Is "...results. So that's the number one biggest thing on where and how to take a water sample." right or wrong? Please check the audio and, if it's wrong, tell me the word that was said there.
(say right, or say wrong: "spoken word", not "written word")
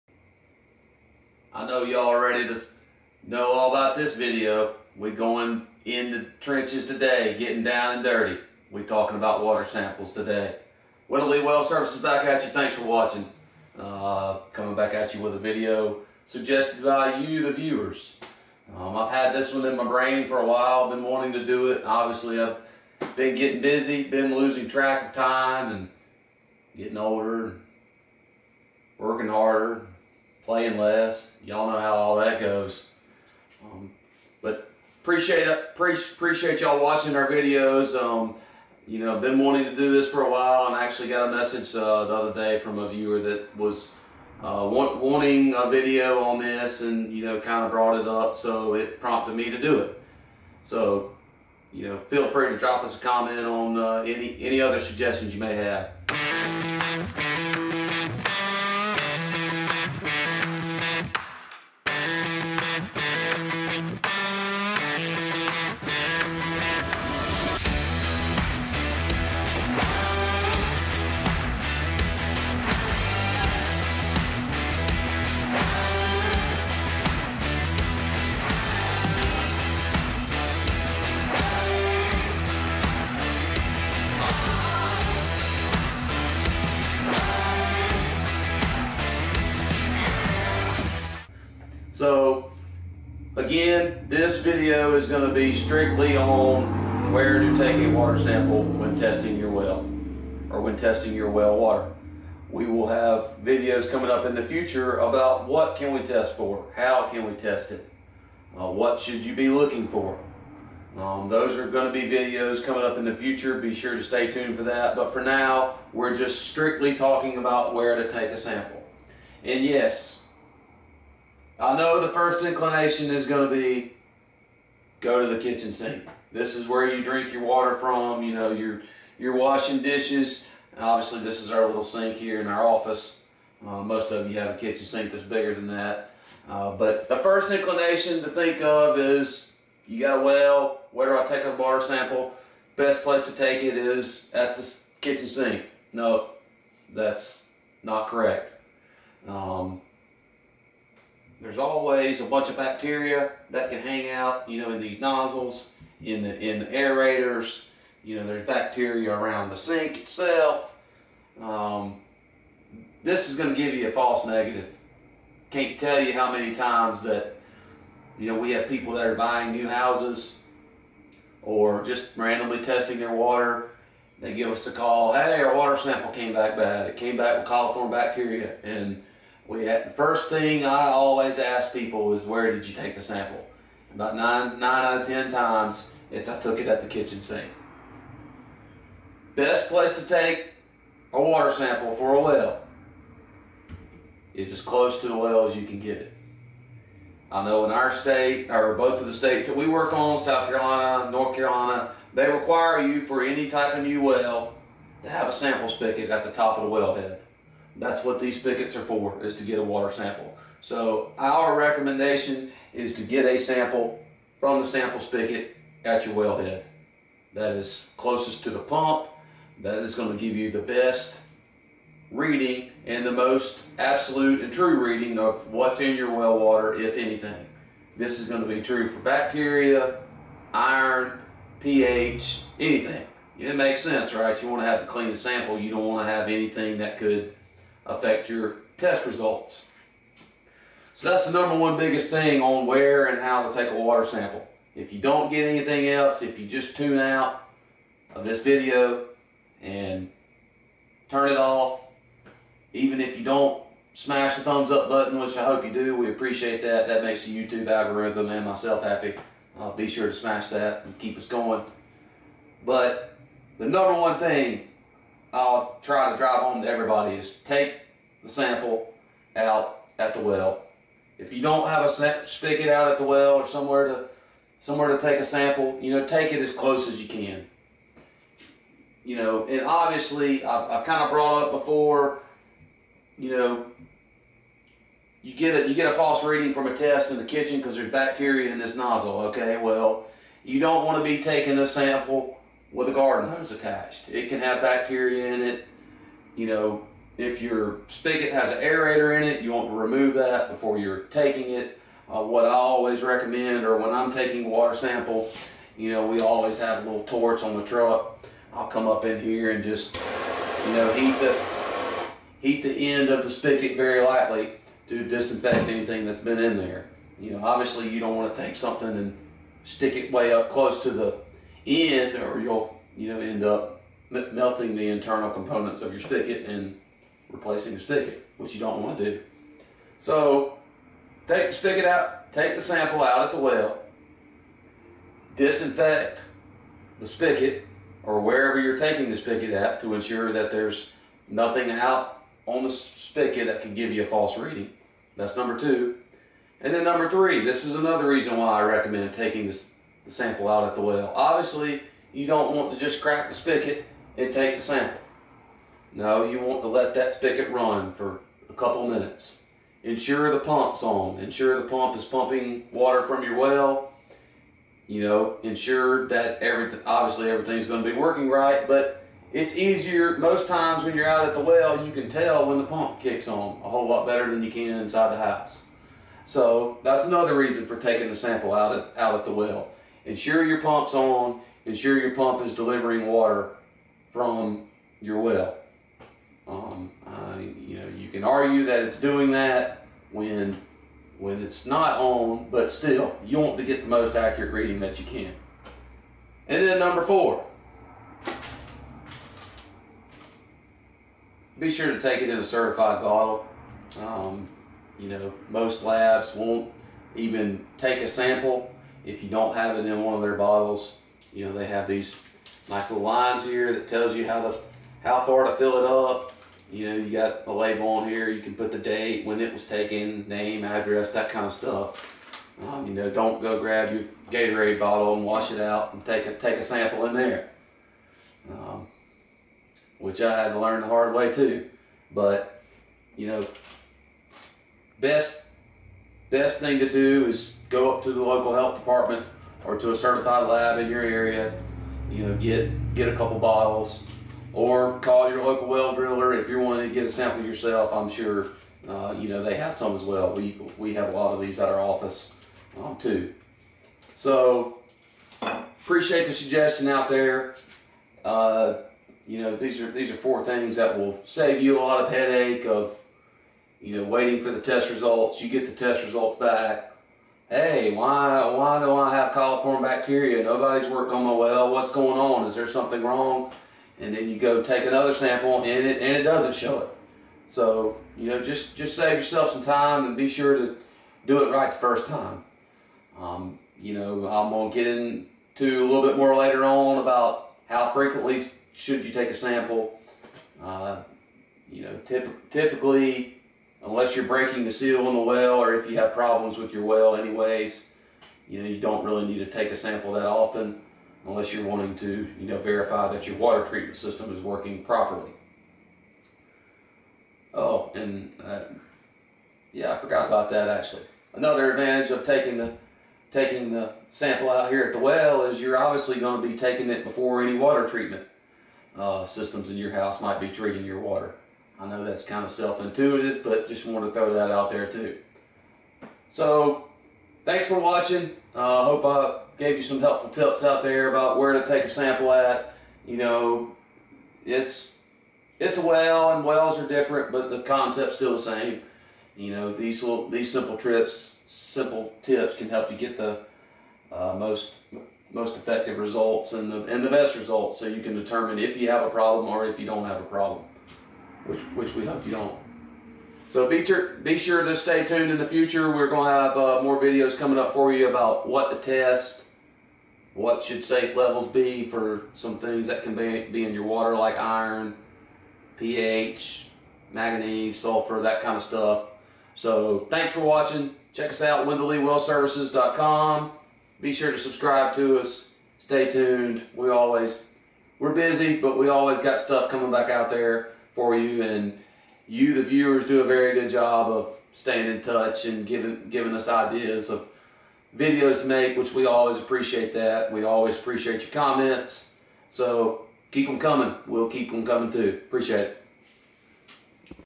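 right.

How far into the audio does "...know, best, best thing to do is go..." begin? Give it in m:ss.
7:13.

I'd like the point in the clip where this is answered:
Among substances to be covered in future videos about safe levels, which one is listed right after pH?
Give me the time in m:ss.
9:27.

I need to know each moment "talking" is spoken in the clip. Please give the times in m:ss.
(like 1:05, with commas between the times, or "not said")
0:08, 1:56.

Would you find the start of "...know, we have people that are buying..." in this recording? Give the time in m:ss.
2:48.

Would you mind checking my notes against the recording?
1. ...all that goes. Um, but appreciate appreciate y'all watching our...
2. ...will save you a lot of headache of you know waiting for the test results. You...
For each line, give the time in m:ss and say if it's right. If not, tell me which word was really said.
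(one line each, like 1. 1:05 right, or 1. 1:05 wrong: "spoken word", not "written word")
1. 0:31 right
2. 7:40 right.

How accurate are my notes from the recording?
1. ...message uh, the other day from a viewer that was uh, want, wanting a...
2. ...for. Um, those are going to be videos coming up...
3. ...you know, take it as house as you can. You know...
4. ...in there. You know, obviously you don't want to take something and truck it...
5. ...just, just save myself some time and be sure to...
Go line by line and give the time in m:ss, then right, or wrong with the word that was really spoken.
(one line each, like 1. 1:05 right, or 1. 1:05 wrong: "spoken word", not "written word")
1. 0:41 right
2. 1:49 right
3. 4:35 wrong: "close", not "house"
4. 5:16 wrong: "stick", not "truck"
5. 7:58 wrong: "yourself", not "myself".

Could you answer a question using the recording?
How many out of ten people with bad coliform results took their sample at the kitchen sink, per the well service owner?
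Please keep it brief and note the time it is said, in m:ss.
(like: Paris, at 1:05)
9, at 3:04.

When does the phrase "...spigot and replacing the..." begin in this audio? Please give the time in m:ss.
5:26.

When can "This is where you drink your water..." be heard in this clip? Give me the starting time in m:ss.
2:06.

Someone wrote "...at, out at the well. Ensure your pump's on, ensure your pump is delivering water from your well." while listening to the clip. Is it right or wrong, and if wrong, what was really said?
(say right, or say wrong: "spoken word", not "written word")
right.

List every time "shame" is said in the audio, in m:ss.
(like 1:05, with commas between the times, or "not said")
not said.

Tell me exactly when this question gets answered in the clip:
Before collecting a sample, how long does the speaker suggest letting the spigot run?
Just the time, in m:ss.
5:58.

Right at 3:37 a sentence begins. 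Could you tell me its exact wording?
That is closest to the pump.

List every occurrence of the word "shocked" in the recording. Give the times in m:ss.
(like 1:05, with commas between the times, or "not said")
not said.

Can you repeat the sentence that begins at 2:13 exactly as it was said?
Uh, most of you have a kitchen sink that's bigger than that.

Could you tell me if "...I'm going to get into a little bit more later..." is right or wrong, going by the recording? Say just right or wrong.
right.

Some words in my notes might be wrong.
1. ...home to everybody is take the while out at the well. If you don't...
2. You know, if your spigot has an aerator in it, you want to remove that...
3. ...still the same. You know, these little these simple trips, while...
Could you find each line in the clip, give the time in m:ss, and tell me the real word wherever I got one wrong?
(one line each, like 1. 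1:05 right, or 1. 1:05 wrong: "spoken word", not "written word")
1. 4:26 wrong: "sample", not "while"
2. 4:56 right
3. 8:58 wrong: "simple", not "while".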